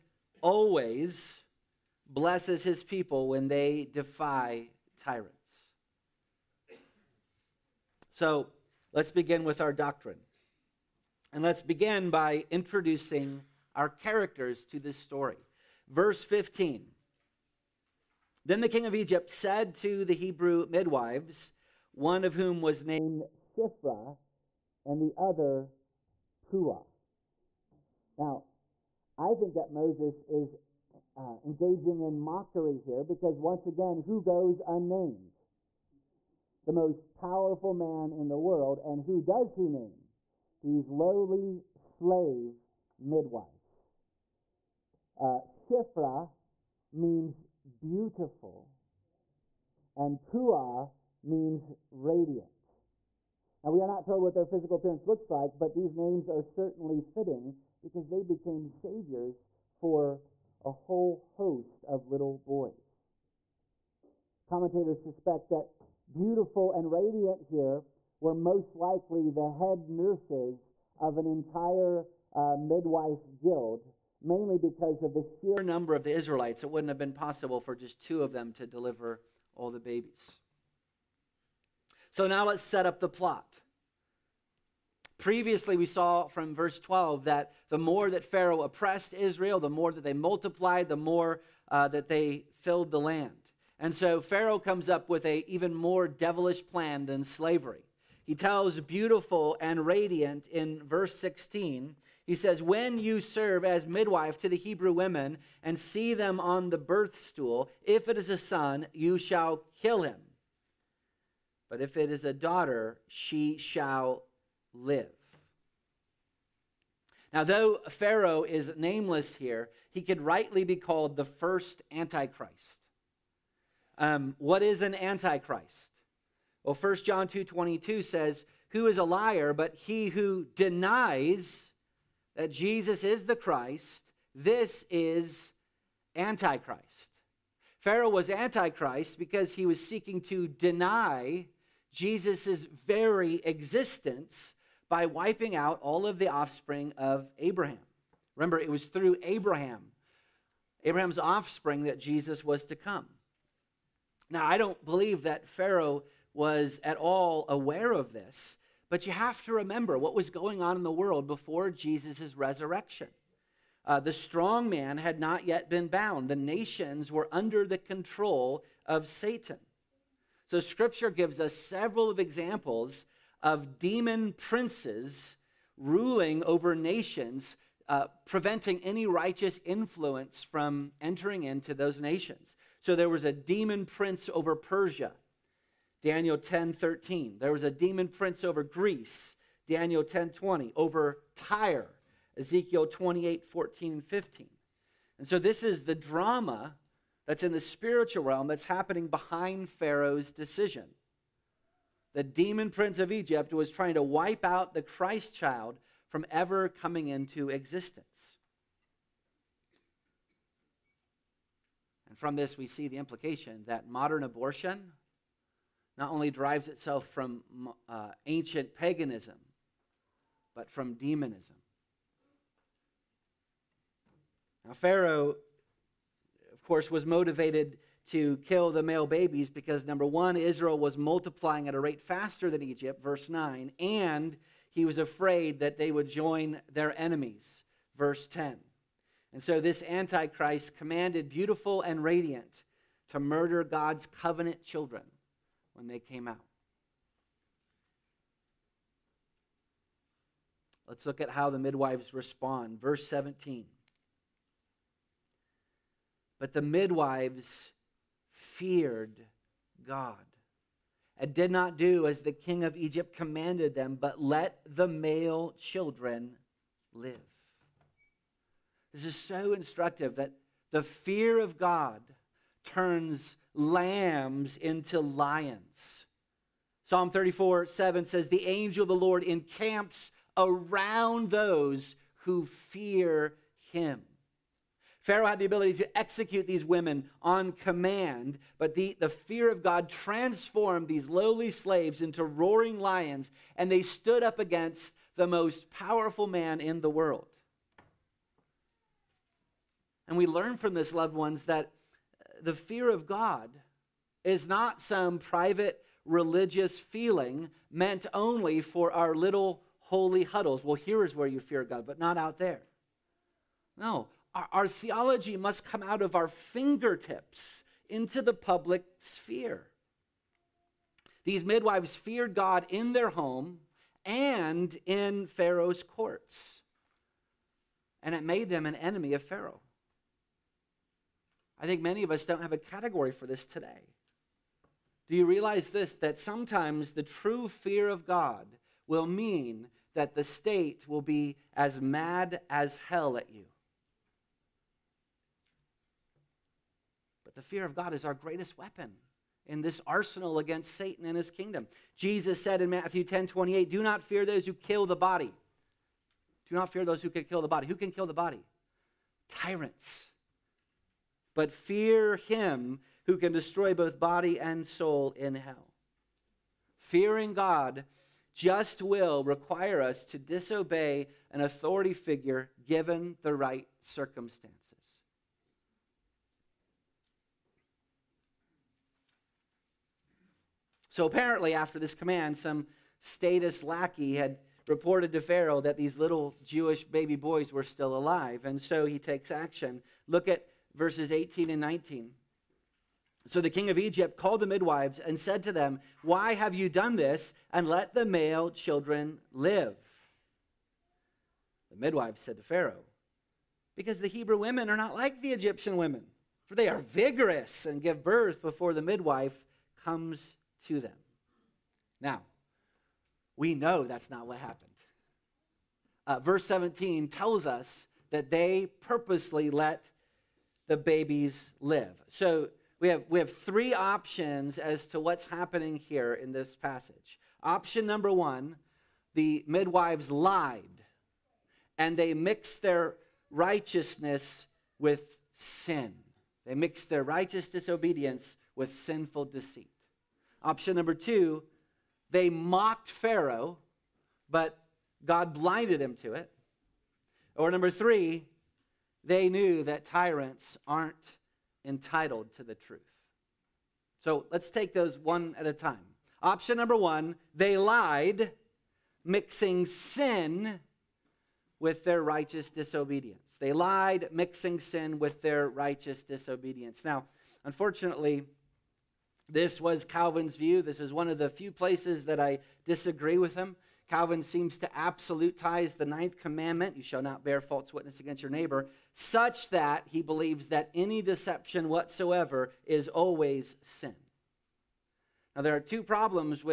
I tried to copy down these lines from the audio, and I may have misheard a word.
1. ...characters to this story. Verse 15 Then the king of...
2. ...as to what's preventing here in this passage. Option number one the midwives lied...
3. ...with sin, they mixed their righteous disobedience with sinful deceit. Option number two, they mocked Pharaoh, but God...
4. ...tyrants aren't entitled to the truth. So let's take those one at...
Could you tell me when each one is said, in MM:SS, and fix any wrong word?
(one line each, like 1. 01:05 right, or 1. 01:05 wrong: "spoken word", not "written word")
1. 00:13 right
2. 07:04 wrong: "happening", not "preventing"
3. 07:14 right
4. 07:29 right.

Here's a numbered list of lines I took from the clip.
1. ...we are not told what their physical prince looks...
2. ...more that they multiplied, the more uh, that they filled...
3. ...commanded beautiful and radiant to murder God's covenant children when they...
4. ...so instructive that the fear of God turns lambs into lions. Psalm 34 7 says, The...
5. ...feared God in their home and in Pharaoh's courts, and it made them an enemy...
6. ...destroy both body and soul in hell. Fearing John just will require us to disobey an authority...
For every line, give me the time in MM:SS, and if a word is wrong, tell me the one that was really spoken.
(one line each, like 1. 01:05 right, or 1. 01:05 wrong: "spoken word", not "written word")
1. 00:53 wrong: "appearance", not "prince"
2. 01:29 right
3. 04:00 right
4. 04:29 right
5. 05:21 right
6. 06:03 wrong: "God", not "John".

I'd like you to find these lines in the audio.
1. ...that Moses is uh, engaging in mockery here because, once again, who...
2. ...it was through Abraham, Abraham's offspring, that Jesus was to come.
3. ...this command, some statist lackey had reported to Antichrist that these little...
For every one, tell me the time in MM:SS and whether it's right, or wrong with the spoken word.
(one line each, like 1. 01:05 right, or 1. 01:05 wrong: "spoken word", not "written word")
1. 00:29 right
2. 02:28 right
3. 06:21 wrong: "Pharaoh", not "Antichrist".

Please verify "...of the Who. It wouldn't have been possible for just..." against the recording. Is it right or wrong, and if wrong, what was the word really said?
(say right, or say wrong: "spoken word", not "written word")
wrong: "Israelites", not "Who".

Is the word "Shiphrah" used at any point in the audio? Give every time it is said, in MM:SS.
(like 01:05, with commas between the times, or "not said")
00:23, 00:45.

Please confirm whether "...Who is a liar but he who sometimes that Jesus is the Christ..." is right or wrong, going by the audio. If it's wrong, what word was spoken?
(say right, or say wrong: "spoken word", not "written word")
wrong: "denies", not "sometimes".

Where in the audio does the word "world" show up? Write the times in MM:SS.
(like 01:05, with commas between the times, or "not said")
00:38, 02:40, 04:56.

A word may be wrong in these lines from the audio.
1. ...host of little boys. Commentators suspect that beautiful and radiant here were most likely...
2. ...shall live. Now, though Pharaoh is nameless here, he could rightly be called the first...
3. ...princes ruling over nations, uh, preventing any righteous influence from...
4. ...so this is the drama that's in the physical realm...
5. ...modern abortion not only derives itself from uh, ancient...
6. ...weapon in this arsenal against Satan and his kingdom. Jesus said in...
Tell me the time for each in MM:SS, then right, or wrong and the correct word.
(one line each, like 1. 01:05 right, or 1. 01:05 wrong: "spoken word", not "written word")
1. 01:01 right
2. 01:53 right
3. 02:54 right
4. 03:15 wrong: "spiritual", not "physical"
5. 03:33 right
6. 05:48 right.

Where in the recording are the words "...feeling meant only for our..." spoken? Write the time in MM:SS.
05:06.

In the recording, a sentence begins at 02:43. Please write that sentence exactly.
Uh, the strong man had not yet been bound, the nations were under the control of Satan.